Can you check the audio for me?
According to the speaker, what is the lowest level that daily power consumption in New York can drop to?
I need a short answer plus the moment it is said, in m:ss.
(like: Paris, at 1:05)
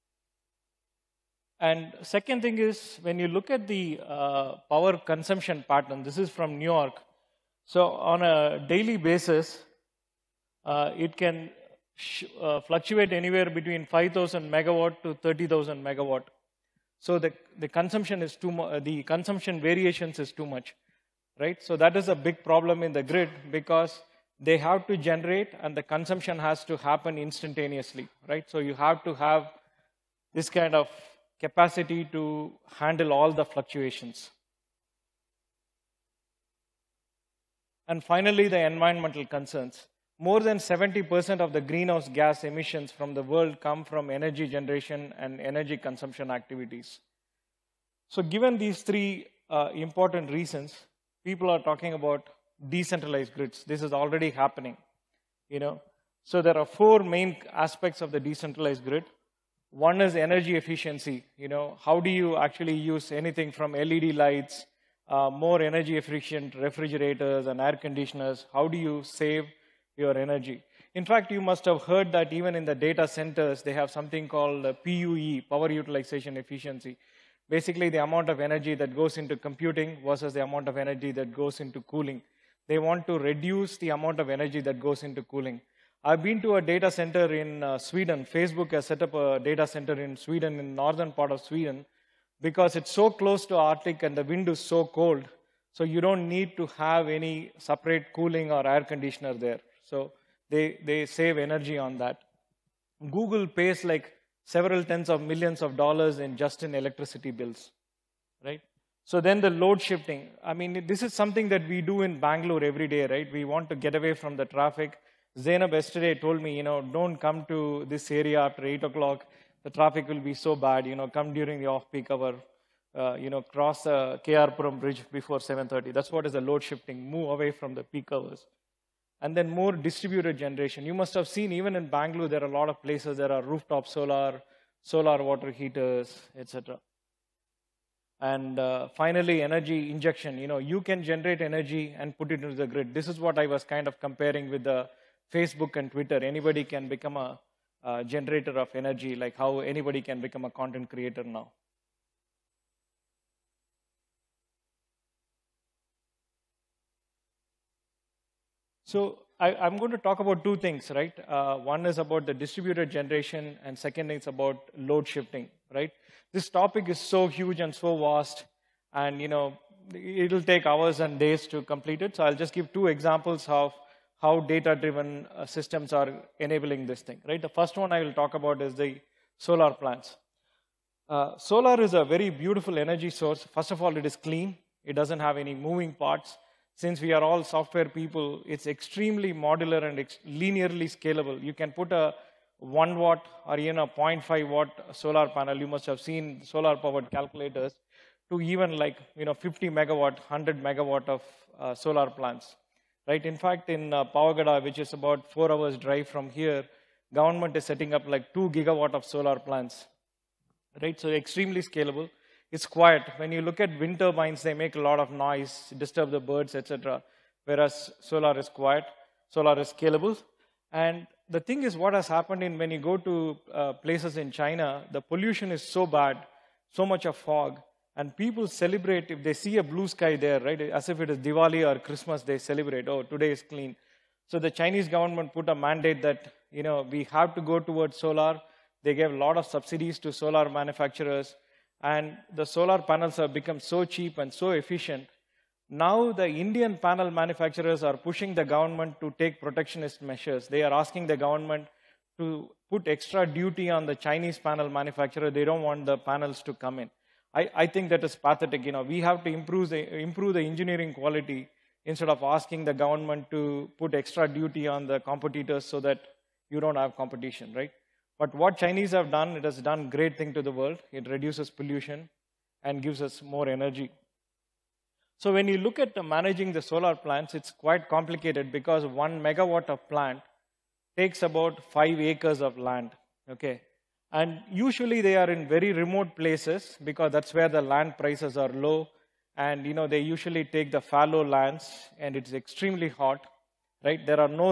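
5,000 megawatt, at 0:13.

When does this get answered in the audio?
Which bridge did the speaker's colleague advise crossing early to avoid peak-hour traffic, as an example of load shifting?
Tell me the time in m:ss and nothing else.
2:04.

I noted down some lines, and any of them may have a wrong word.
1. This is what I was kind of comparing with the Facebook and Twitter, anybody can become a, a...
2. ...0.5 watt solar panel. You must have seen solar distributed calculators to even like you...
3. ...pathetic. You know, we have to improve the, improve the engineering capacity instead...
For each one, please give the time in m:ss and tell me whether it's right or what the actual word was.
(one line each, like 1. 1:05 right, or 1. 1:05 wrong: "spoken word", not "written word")
1. 2:22 right
2. 3:13 wrong: "powered", not "distributed"
3. 4:18 wrong: "quality", not "capacity".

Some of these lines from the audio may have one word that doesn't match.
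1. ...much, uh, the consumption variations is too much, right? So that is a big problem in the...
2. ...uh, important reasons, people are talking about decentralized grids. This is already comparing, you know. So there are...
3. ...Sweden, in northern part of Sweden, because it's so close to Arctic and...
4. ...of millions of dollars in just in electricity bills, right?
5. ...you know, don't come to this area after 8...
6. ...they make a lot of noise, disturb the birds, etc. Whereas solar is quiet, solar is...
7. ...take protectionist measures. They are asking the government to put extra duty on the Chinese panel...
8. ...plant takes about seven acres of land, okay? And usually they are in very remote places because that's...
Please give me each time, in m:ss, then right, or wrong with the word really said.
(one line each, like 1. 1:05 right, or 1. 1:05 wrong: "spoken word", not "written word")
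1. 0:18 right
2. 0:49 wrong: "happening", not "comparing"
3. 1:30 right
4. 1:45 right
5. 1:56 right
6. 3:34 right
7. 4:09 right
8. 4:39 wrong: "five", not "seven".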